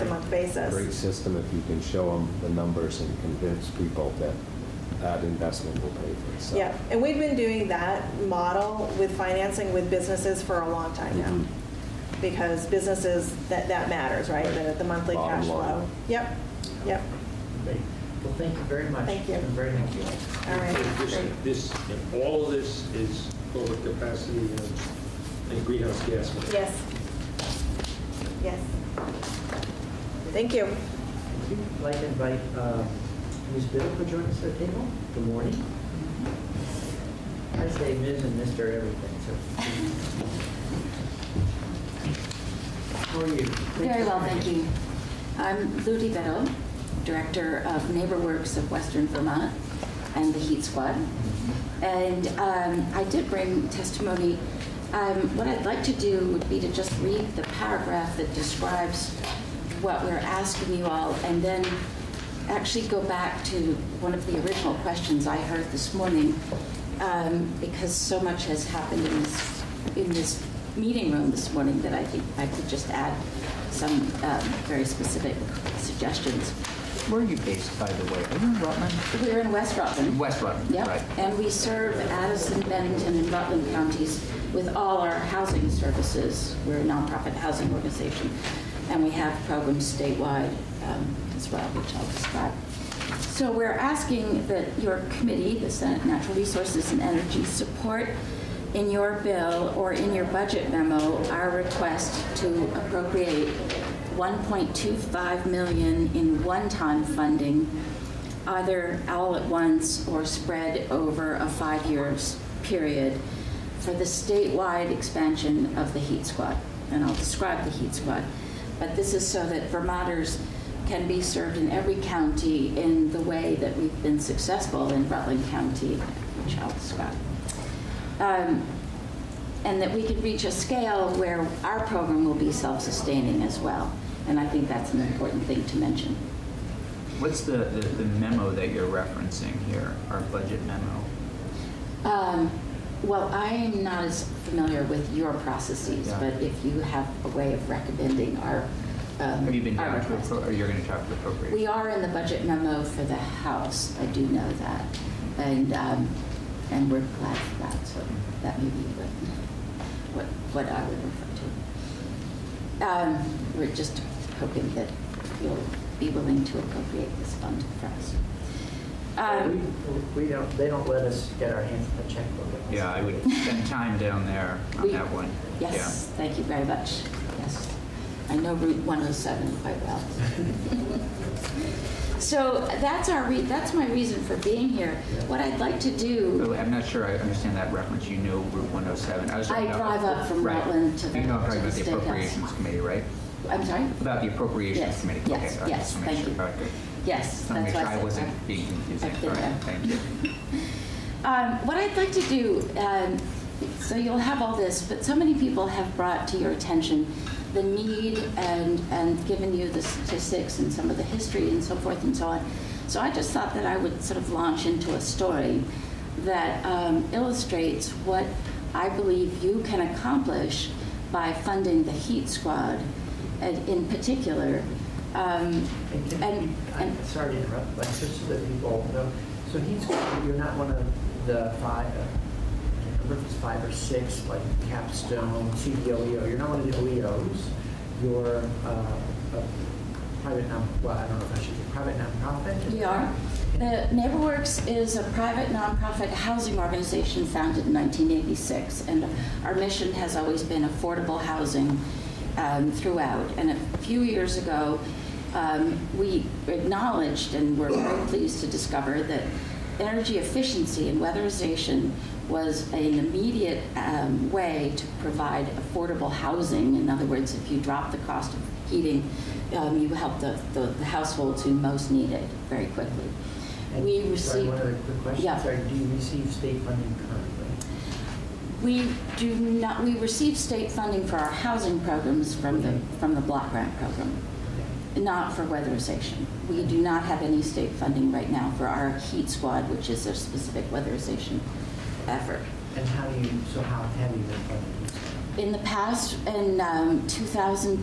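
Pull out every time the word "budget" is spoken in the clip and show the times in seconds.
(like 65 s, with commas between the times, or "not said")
100 s, 140 s, 152 s.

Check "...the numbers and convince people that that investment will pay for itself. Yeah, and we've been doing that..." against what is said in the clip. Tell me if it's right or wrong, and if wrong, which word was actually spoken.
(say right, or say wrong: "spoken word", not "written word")
right.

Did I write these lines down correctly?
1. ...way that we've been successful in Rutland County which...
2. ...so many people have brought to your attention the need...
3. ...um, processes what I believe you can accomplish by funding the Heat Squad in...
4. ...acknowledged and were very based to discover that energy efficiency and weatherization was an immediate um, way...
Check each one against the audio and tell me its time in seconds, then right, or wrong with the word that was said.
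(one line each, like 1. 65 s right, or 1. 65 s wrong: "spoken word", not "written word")
1. 123 s right
2. 205 s right
3. 216 s wrong: "illustrates", not "processes"
4. 256 s wrong: "pleased", not "based".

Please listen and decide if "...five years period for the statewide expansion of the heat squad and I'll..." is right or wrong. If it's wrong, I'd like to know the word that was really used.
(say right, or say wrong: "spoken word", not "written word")
right.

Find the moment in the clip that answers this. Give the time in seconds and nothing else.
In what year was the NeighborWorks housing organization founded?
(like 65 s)
247 s.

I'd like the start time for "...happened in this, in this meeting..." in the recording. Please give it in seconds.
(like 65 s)
68 s.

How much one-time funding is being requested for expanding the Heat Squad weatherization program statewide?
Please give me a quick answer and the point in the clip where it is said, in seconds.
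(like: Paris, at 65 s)
$1.25 million, at 104 s.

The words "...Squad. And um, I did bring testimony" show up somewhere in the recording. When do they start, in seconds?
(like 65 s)
50 s.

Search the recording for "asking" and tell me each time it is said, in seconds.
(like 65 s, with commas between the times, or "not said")
60 s, 93 s.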